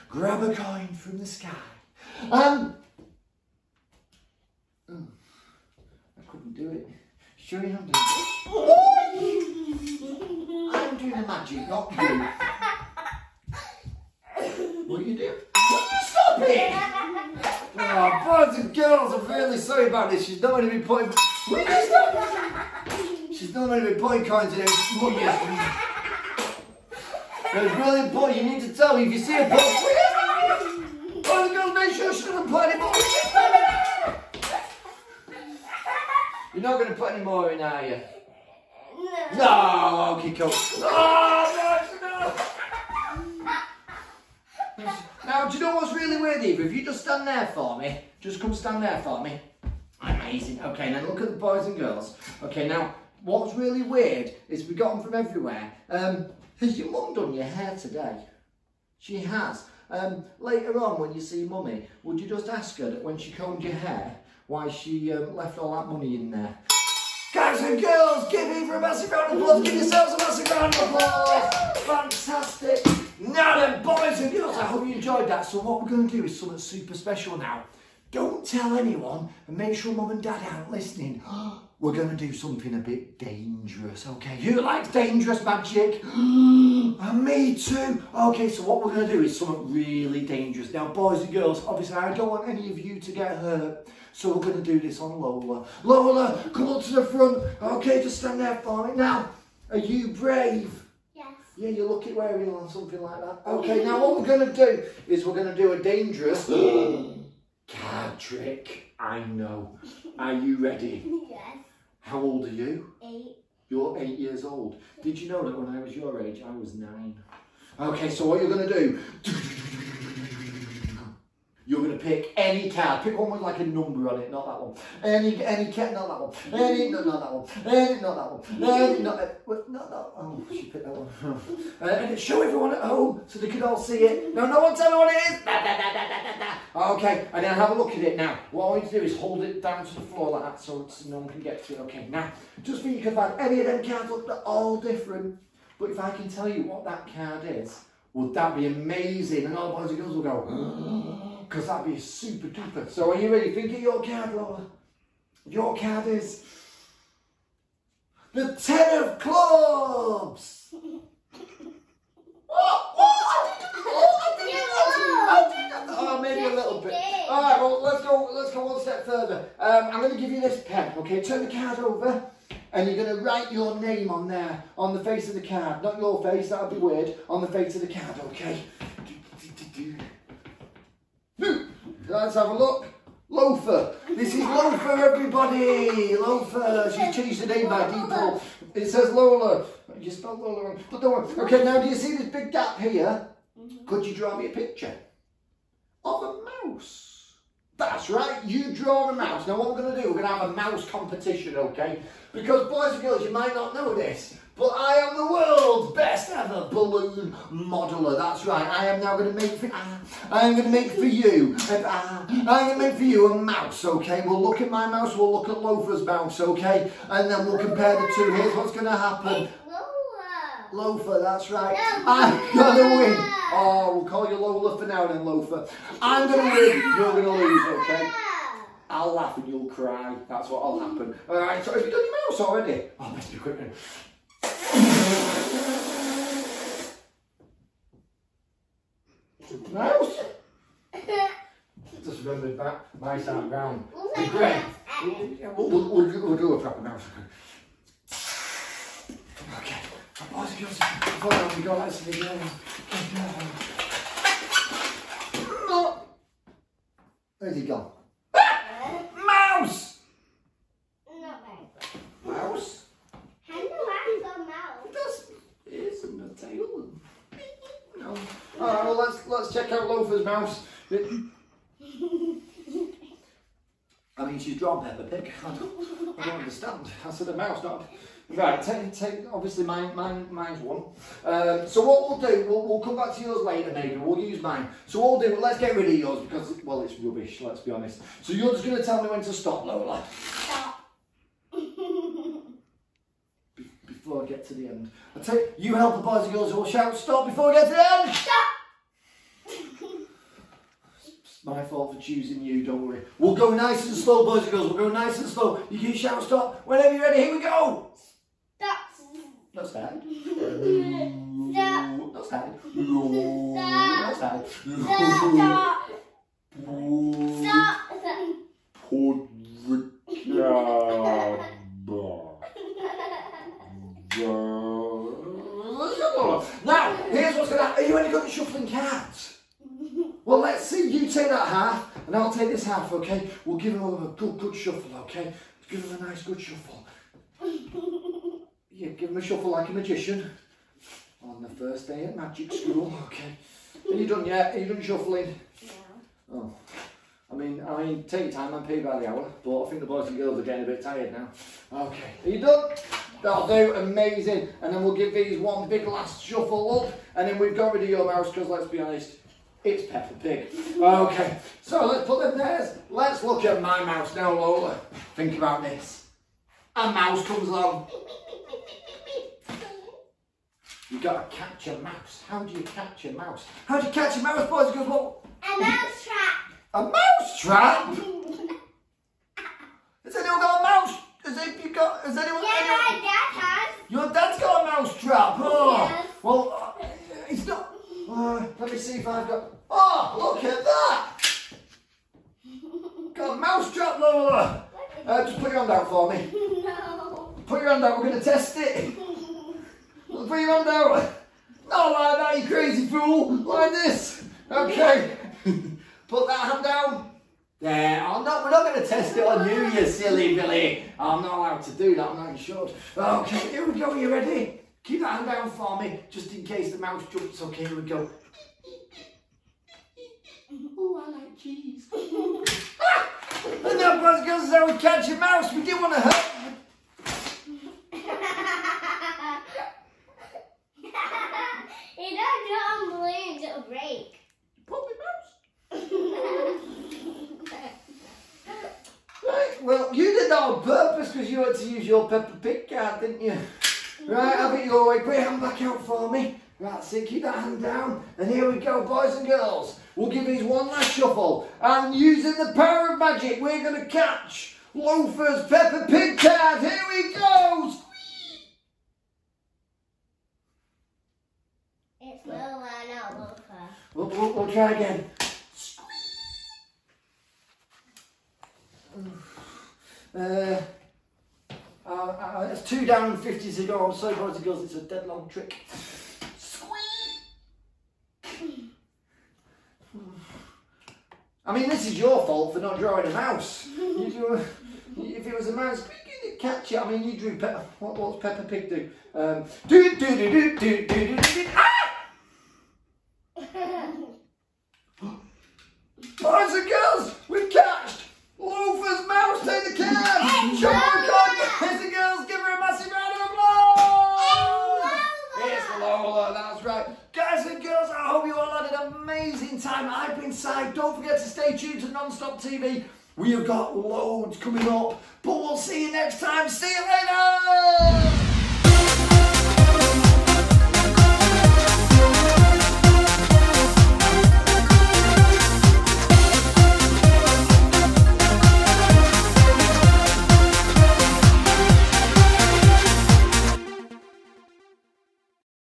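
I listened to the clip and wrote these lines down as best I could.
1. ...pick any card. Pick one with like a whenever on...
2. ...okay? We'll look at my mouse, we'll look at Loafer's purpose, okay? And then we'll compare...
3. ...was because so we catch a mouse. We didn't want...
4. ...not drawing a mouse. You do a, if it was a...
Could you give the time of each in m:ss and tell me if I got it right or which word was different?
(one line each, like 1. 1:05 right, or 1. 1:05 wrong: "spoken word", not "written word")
1. 2:02 wrong: "number", not "whenever"
2. 3:33 wrong: "mouse", not "purpose"
3. 7:04 right
4. 8:02 right.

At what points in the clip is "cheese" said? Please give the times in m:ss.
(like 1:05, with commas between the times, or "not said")
7:01.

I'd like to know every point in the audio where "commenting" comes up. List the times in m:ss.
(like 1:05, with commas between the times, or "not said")
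not said.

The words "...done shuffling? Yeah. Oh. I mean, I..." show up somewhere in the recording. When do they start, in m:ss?
5:44.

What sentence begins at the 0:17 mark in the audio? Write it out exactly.
oh, boys and girls, I'm really sorry about this.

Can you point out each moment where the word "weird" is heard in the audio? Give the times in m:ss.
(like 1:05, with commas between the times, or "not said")
0:46, 0:53, 2:56.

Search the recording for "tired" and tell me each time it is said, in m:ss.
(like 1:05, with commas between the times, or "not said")
5:50.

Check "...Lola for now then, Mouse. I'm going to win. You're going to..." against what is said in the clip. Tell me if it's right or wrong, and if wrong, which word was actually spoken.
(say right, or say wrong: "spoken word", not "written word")
wrong: "Loafer", not "Mouse".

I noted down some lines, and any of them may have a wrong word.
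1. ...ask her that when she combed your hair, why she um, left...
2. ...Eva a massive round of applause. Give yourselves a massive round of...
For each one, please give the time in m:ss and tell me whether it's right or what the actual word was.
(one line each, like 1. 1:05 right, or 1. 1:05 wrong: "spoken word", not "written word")
1. 1:02 right
2. 1:08 right.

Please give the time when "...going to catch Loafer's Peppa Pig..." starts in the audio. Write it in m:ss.
7:33.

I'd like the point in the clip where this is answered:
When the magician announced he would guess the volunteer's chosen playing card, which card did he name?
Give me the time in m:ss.
2:38.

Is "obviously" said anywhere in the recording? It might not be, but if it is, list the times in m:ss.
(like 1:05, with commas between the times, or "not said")
1:31, 4:39.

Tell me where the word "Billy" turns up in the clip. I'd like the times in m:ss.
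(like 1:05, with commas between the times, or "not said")
6:50.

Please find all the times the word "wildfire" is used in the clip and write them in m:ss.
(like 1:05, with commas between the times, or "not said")
not said.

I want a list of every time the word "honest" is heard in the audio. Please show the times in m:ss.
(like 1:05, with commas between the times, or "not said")
4:47, 5:58.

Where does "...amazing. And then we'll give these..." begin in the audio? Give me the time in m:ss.
5:53.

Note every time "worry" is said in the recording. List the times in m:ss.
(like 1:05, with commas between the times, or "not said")
3:11, 5:02.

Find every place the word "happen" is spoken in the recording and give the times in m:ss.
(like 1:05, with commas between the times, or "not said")
3:38, 3:50, 5:27.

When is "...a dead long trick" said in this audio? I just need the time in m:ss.
7:54.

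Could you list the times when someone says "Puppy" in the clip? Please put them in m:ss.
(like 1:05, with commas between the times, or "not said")
7:14.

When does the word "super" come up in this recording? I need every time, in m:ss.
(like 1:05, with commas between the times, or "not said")
1:16, 2:32.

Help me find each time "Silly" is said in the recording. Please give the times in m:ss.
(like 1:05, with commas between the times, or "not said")
6:50.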